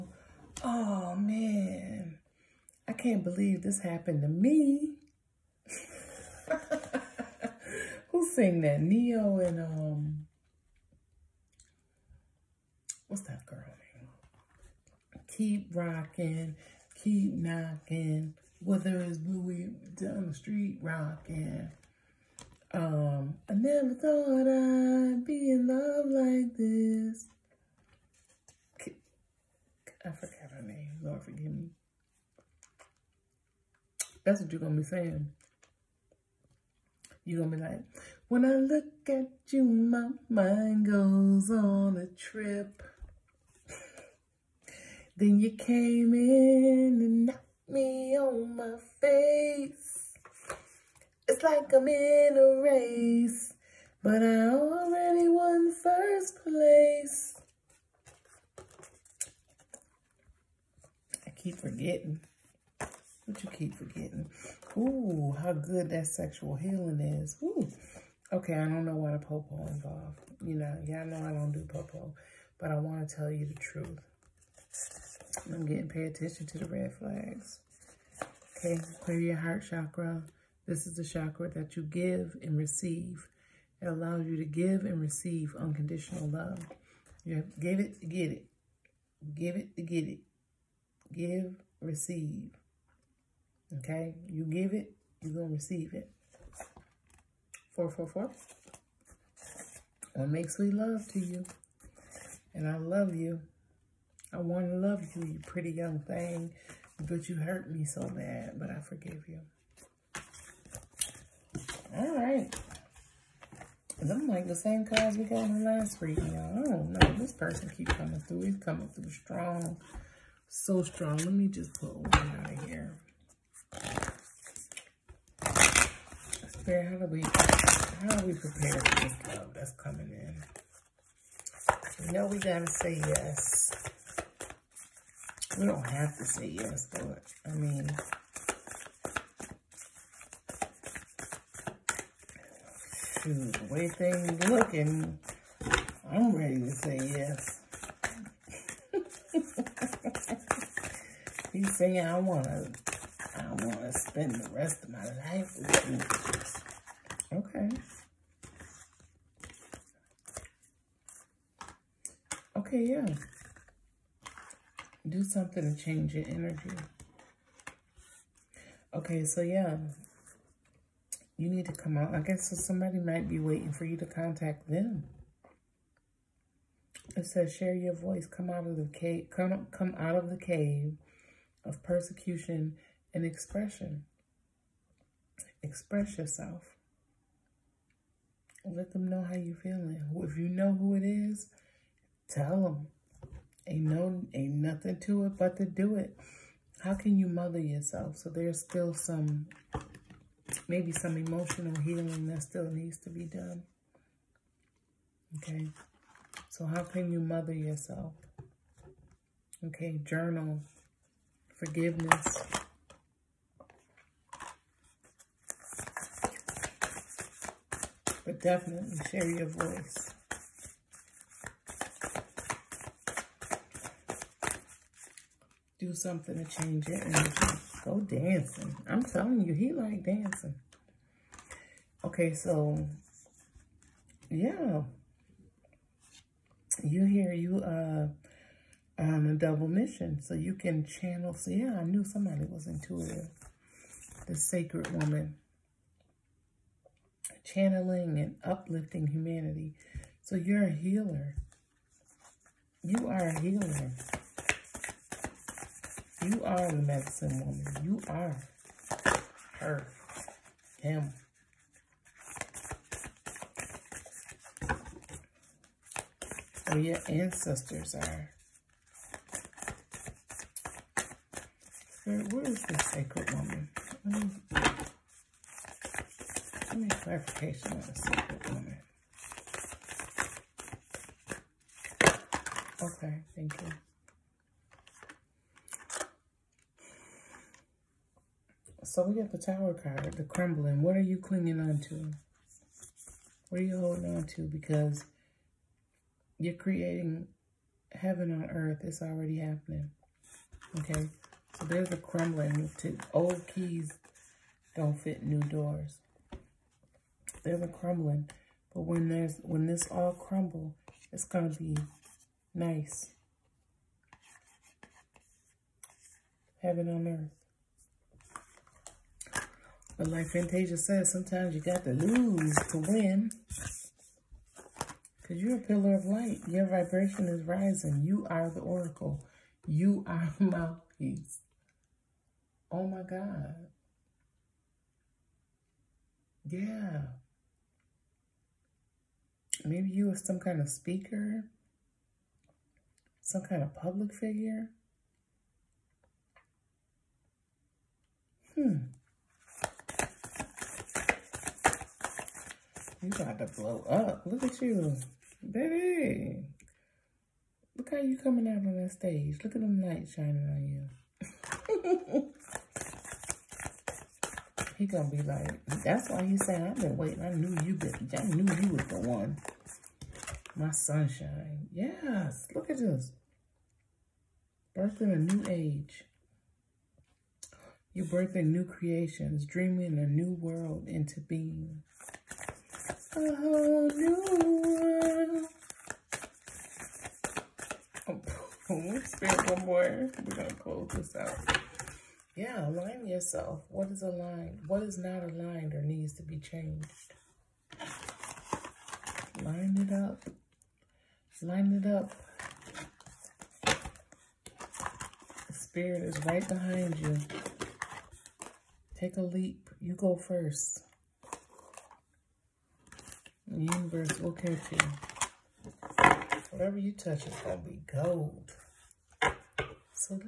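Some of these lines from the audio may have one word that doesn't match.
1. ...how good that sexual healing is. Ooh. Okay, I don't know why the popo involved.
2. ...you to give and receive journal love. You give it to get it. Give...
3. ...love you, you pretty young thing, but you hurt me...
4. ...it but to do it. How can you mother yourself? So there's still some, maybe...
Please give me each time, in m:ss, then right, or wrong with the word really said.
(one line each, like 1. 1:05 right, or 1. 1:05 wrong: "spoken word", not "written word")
1. 1:05 right
2. 1:24 wrong: "unconditional", not "journal"
3. 1:44 right
4. 3:15 right.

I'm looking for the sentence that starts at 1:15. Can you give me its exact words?
I'm getting pay attention to the red flags.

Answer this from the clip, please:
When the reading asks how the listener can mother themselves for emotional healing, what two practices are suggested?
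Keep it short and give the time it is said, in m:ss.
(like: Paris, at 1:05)
journal, forgiveness, at 3:30.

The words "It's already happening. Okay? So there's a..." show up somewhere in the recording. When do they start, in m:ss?
4:58.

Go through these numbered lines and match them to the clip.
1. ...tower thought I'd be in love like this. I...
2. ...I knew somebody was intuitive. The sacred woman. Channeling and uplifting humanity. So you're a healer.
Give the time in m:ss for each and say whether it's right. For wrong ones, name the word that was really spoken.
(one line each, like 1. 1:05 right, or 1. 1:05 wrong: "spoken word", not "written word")
1. 0:23 wrong: "never", not "tower"
2. 4:01 right.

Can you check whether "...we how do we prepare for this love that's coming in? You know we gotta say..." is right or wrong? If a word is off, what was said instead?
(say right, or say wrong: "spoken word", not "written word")
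right.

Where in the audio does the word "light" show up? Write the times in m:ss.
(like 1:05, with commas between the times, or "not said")
5:26, 5:59.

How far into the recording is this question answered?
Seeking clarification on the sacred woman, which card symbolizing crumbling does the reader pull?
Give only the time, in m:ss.
4:49.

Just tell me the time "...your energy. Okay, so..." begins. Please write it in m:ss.
2:46.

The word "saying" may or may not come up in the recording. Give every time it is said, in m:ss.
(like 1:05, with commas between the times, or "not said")
0:34, 2:31.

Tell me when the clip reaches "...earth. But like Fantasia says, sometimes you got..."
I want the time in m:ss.
5:17.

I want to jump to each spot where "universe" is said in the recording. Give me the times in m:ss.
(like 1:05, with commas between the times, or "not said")
6:53.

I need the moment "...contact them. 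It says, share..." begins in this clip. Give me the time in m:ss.
2:54.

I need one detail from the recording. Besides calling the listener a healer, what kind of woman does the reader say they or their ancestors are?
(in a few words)
medicine woman.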